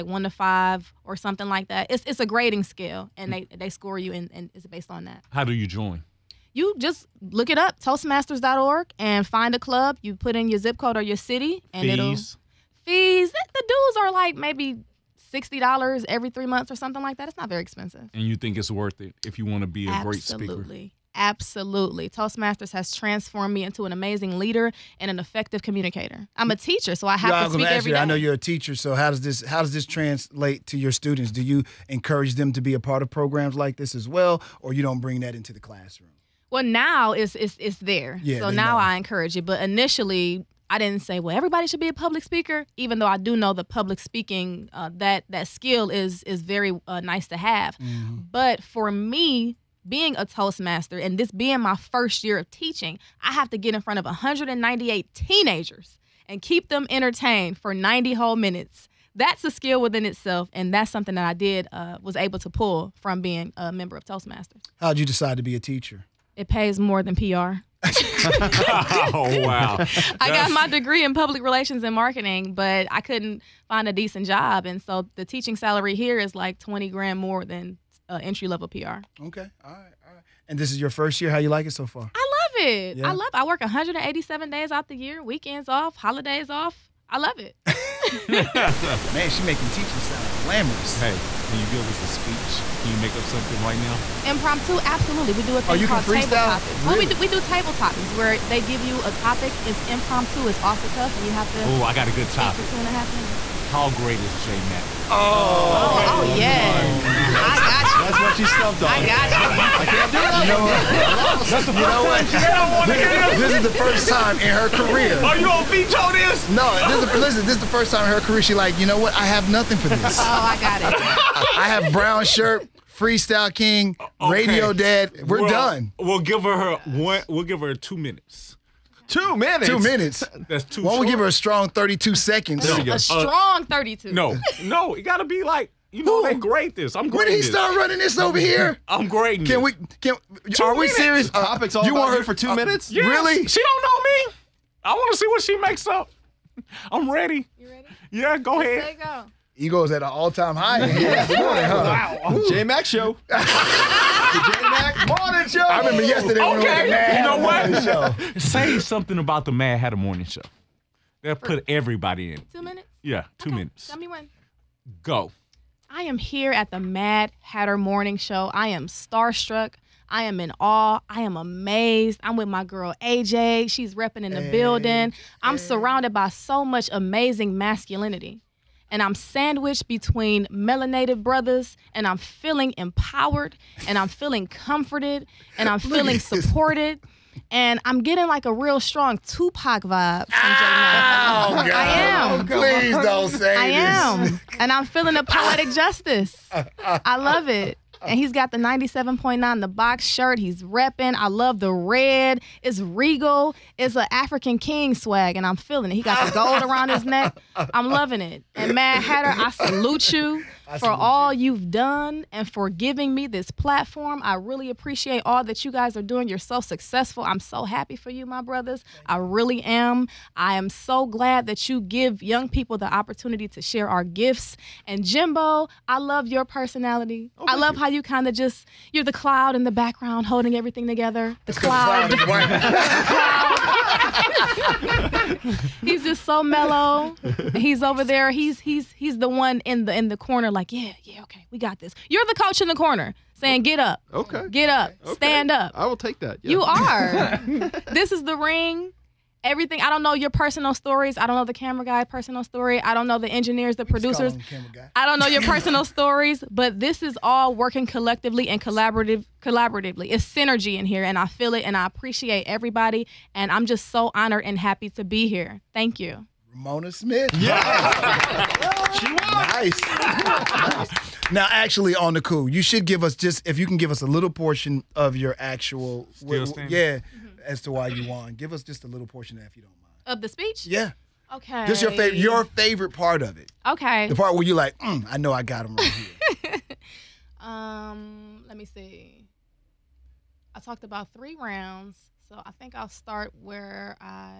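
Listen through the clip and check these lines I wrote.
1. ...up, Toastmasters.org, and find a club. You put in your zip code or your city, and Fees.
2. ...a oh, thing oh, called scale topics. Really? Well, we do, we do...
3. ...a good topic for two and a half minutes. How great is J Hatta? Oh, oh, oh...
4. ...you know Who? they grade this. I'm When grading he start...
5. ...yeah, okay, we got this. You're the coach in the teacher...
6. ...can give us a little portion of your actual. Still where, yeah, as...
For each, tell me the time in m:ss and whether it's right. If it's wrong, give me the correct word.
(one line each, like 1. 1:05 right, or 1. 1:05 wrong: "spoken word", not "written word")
1. 0:07 right
2. 1:35 wrong: "table", not "scale"
3. 1:42 wrong: "Mac", not "Hatta"
4. 2:15 right
5. 4:01 wrong: "corner", not "teacher"
6. 4:33 right.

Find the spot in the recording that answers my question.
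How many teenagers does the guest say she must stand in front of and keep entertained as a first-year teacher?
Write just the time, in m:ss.
0:54.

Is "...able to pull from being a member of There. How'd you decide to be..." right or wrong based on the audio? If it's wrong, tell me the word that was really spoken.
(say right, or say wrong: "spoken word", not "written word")
wrong: "Toastmasters", not "There".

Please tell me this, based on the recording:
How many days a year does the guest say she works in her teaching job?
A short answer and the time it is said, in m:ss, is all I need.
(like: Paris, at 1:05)
187, at 1:23.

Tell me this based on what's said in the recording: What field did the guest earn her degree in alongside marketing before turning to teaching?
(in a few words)
Public relations.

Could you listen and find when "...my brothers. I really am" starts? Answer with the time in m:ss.
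3:38.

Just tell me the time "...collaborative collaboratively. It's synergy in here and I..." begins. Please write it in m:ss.
4:18.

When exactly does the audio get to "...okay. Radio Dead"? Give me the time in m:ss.
2:04.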